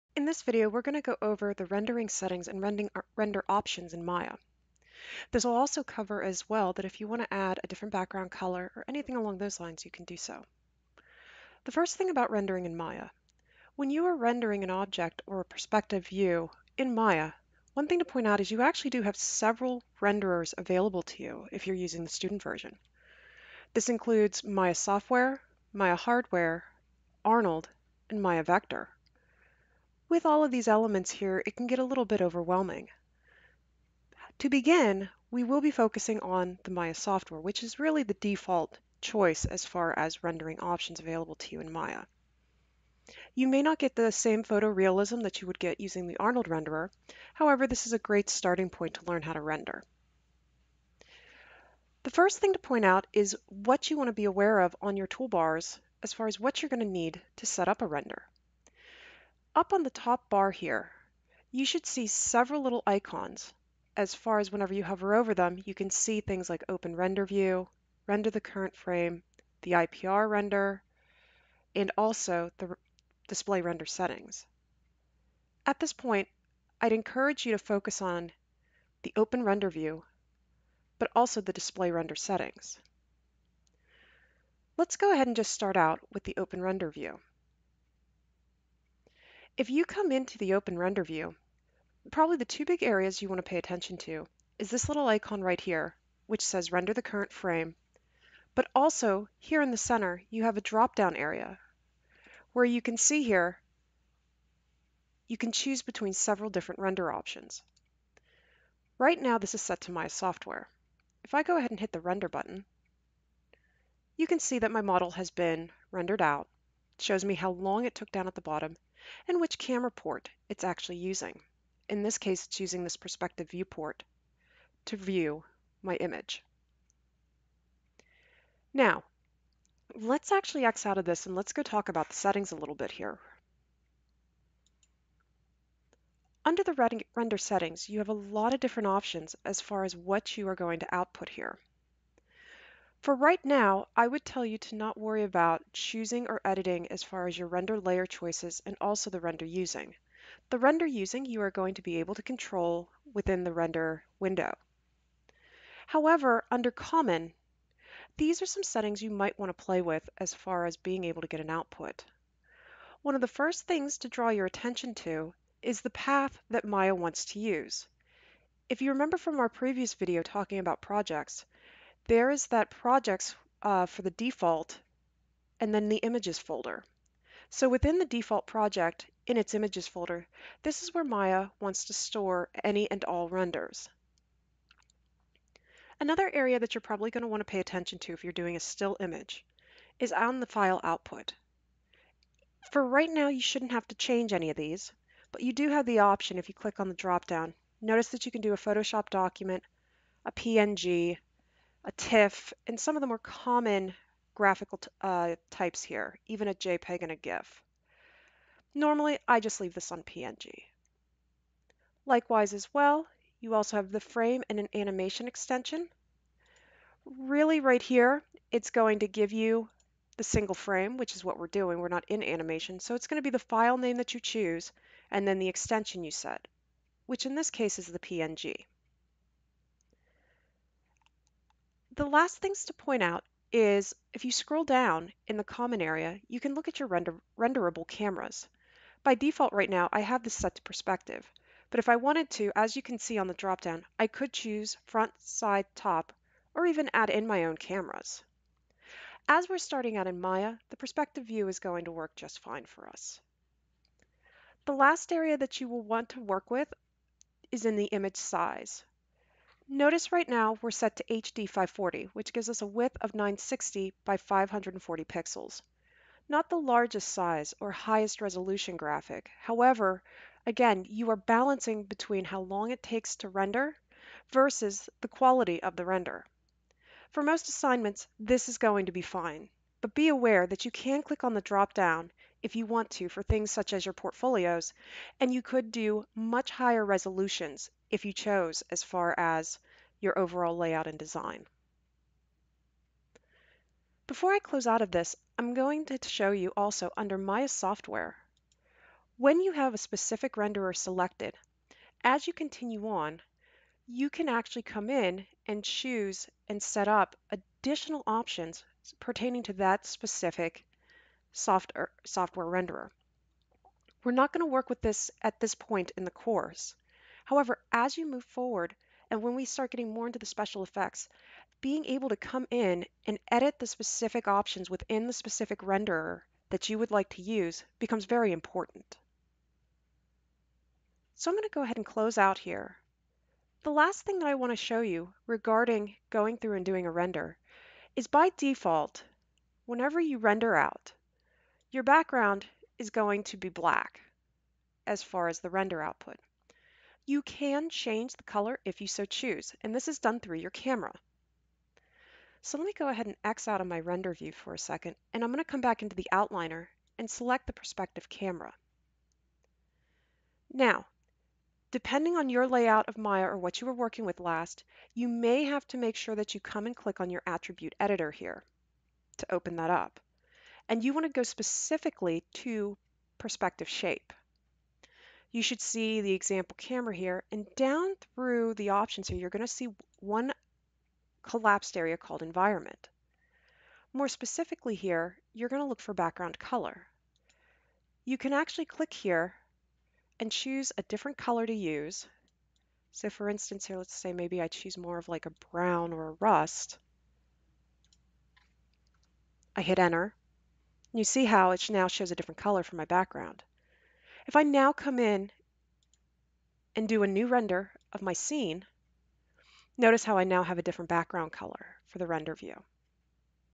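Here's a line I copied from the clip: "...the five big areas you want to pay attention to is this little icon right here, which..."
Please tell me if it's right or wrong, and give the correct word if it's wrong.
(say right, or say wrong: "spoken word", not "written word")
wrong: "two", not "five".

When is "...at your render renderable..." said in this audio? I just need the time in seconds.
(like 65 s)
236 s.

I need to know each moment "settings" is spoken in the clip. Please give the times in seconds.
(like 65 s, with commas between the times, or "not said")
2 s, 73 s, 82 s, 132 s, 137 s, 158 s.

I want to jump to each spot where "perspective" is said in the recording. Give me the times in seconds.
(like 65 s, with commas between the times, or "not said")
15 s, 122 s, 240 s, 250 s, 357 s, 373 s.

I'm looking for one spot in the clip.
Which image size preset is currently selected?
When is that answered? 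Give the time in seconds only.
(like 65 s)
261 s.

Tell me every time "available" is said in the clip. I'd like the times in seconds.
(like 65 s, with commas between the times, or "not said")
20 s, 40 s.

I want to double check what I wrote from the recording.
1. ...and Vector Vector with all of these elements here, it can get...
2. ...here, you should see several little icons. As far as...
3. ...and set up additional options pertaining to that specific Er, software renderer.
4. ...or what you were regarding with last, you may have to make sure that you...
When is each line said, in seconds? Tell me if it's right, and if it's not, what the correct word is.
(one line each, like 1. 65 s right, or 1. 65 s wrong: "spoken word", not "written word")
1. 28 s wrong: "Maya", not "Vector"
2. 60 s right
3. 306 s right
4. 363 s wrong: "working", not "regarding".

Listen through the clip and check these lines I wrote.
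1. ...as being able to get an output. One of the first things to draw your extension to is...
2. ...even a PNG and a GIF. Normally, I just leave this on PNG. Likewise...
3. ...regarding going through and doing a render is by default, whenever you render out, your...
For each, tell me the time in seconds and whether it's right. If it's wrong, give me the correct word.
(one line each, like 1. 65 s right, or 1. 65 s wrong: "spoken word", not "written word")
1. 160 s wrong: "attention", not "extension"
2. 206 s wrong: "JPEG", not "PNG"
3. 335 s right.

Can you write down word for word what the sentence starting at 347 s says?
You can change the color if you so choose, and this is done through your camera.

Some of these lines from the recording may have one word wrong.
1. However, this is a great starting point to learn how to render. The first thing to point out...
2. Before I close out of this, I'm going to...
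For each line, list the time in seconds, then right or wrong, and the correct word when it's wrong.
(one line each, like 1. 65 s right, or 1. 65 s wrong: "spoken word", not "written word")
1. 47 s right
2. 294 s right.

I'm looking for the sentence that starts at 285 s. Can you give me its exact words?
And you could do much higher resolutions if you chose as far as your overall layout and design.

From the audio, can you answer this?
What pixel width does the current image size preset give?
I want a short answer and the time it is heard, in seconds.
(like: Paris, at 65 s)
960, at 263 s.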